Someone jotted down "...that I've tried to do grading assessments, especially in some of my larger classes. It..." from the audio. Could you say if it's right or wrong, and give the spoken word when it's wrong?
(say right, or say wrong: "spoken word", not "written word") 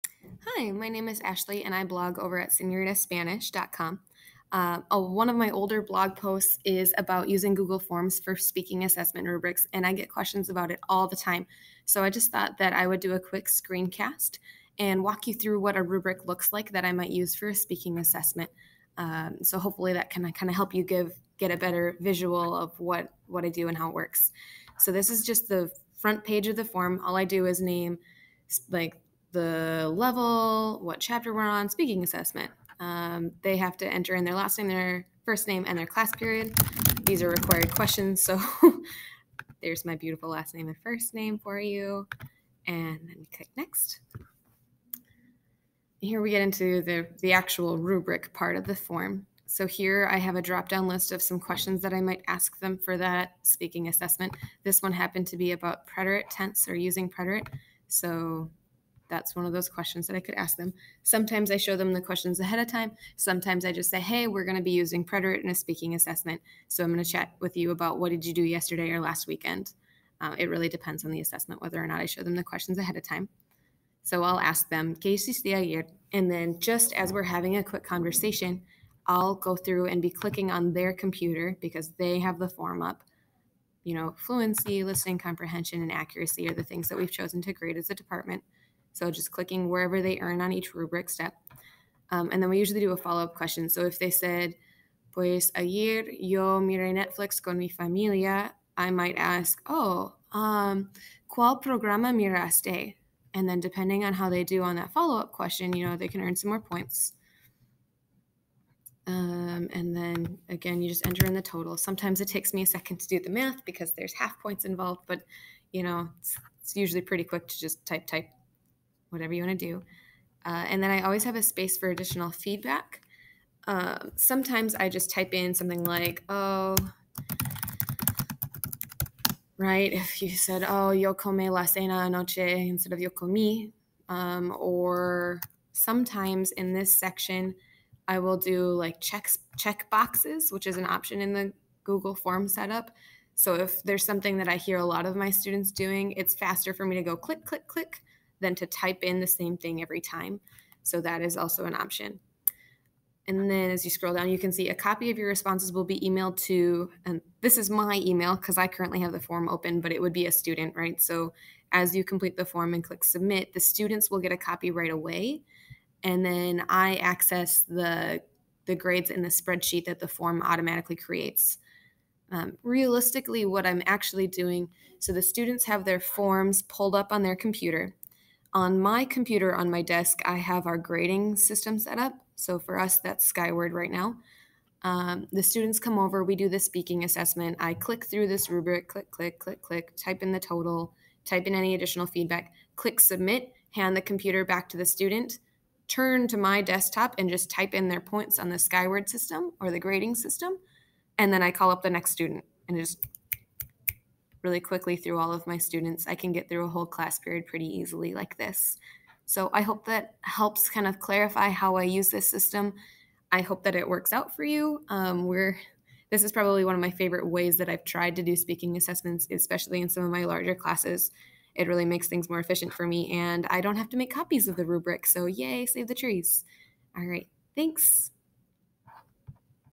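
wrong: "speaking", not "grading".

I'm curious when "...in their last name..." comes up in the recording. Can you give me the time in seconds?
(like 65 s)
34 s.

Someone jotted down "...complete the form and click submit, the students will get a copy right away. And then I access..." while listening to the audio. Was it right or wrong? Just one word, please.
right.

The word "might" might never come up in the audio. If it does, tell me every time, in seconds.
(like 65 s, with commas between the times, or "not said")
16 s, 52 s, 98 s.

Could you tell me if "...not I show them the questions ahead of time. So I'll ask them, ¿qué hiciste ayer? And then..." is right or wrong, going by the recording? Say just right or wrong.
right.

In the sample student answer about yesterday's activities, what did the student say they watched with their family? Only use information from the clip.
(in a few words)
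Netflix.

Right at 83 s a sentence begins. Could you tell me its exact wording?
You know, fluency, listening comprehension, and accuracy are the things that we've chosen to grade as a department.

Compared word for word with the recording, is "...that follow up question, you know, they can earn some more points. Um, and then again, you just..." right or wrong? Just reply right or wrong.
right.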